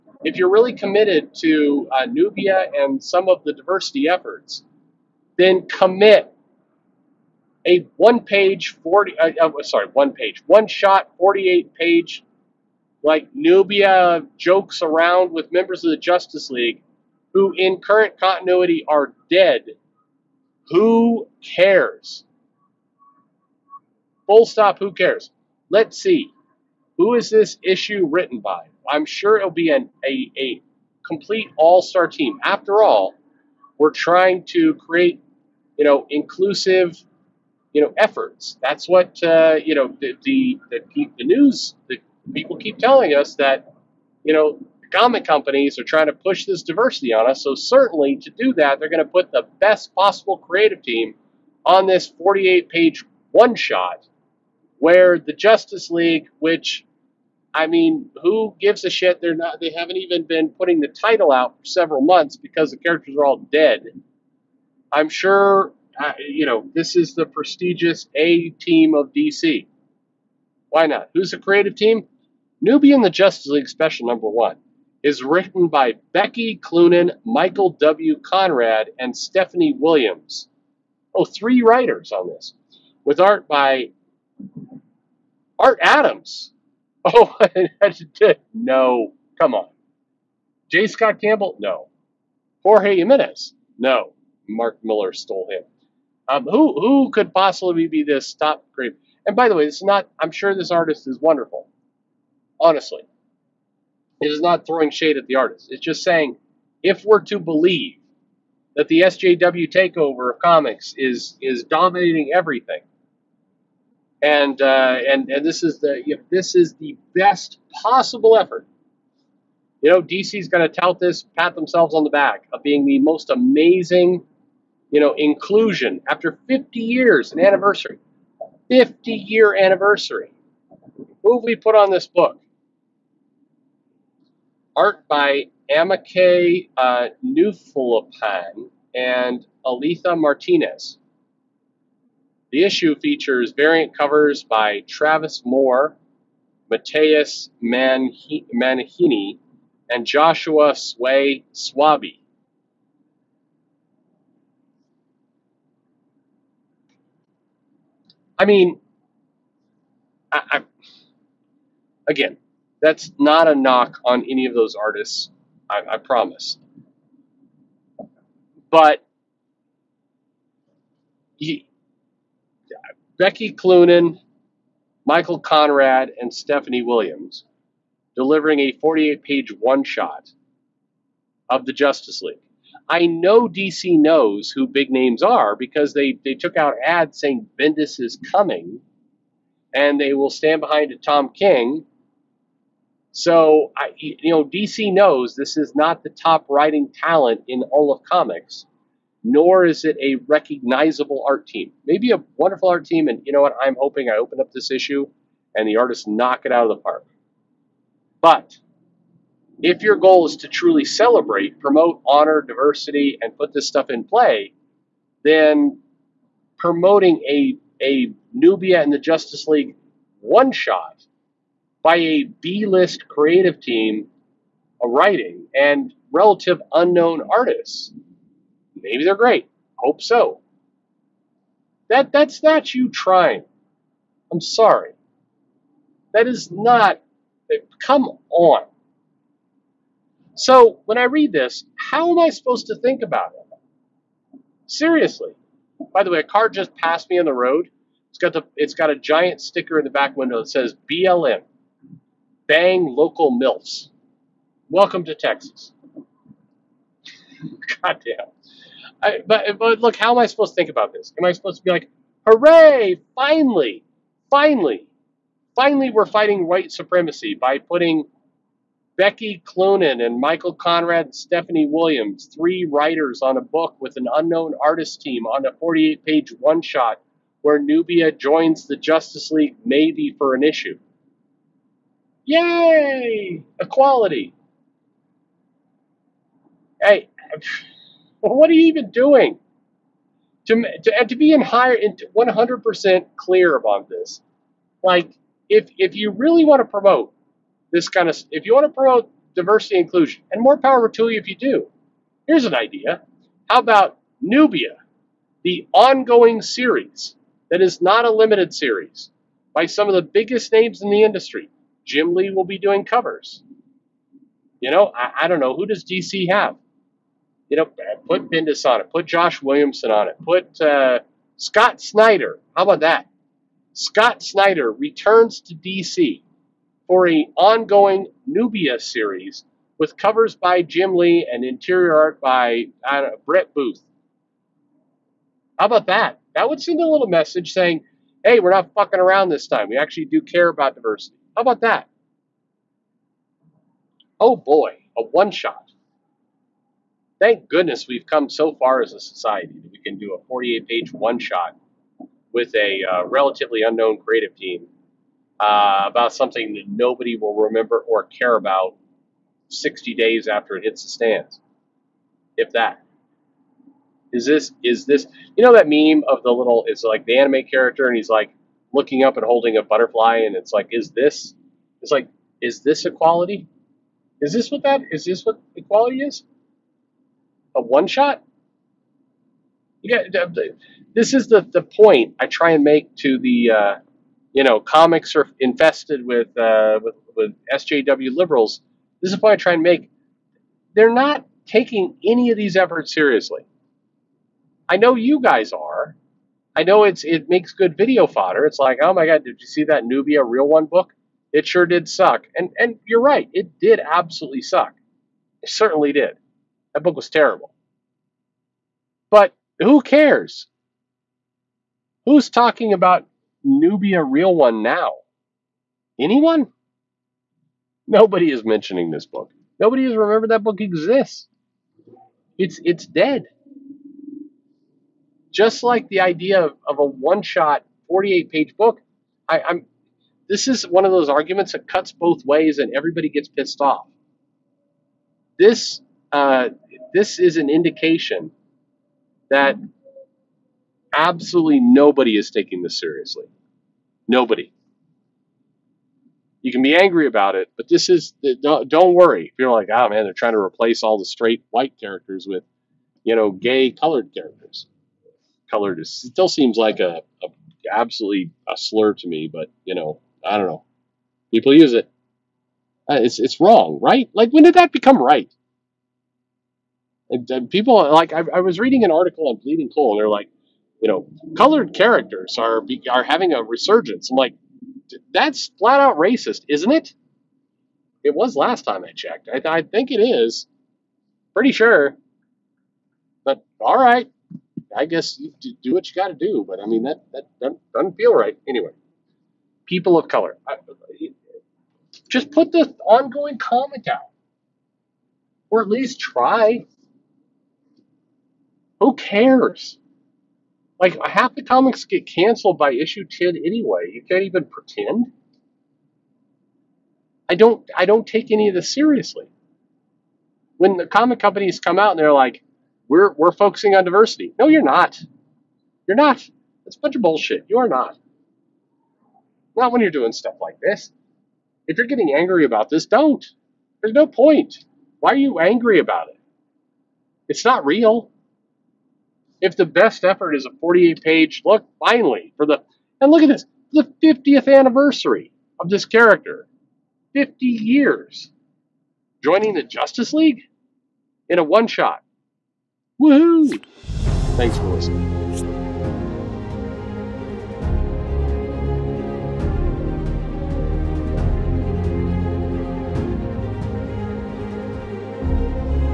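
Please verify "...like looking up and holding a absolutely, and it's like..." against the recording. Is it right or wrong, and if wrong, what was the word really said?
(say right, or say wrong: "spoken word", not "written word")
wrong: "butterfly", not "absolutely".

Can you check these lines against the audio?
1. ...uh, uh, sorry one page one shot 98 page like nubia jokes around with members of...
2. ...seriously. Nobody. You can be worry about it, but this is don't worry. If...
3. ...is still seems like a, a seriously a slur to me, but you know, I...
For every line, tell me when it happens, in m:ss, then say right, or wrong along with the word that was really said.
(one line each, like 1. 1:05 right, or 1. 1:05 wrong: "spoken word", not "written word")
1. 0:09 wrong: "48", not "98"
2. 7:22 wrong: "angry", not "worry"
3. 7:35 wrong: "absolutely", not "seriously".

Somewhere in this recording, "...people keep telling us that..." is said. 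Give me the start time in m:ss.
0:42.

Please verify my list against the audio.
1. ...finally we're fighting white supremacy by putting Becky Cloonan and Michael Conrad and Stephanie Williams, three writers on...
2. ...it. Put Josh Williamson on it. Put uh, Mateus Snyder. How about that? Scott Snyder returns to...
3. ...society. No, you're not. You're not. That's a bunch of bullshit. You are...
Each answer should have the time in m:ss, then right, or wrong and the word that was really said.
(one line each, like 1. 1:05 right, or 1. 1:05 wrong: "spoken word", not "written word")
1. 4:25 right
2. 5:18 wrong: "Scott", not "Mateus"
3. 8:33 wrong: "diversity", not "society".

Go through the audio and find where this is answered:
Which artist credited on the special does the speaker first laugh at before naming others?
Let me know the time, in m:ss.
1:25.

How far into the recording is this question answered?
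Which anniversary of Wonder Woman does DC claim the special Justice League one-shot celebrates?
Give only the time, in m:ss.
2:08.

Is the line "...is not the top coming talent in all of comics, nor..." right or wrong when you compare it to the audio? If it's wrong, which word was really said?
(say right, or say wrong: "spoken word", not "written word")
wrong: "writing", not "coming".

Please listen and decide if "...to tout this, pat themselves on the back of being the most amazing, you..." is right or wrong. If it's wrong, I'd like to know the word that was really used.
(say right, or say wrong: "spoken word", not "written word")
right.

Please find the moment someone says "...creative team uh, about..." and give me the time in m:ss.
5:53.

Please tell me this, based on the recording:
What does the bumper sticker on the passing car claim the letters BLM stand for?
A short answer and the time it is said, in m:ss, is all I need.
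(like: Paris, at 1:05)
Bang local MILFs, at 4:12.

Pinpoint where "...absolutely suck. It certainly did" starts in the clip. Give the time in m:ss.
6:43.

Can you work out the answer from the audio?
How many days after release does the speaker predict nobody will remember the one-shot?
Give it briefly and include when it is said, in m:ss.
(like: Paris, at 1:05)
60, at 5:59.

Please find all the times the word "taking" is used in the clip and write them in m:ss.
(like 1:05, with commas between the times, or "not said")
6:31, 7:22.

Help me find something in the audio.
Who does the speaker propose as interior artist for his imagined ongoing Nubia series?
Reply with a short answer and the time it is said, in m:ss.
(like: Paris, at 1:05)
Brett Booth, at 5:33.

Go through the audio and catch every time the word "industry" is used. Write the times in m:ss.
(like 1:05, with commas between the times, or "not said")
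5:11.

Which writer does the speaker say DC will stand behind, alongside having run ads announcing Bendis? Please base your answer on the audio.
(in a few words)
Tom King.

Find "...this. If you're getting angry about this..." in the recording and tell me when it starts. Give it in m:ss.
8:40.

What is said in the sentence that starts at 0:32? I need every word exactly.
After all, we're trying to create, you know, inclusive, you know, efforts.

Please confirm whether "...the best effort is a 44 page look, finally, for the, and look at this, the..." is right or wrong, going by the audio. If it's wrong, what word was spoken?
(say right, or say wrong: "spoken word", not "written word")
wrong: "48", not "44".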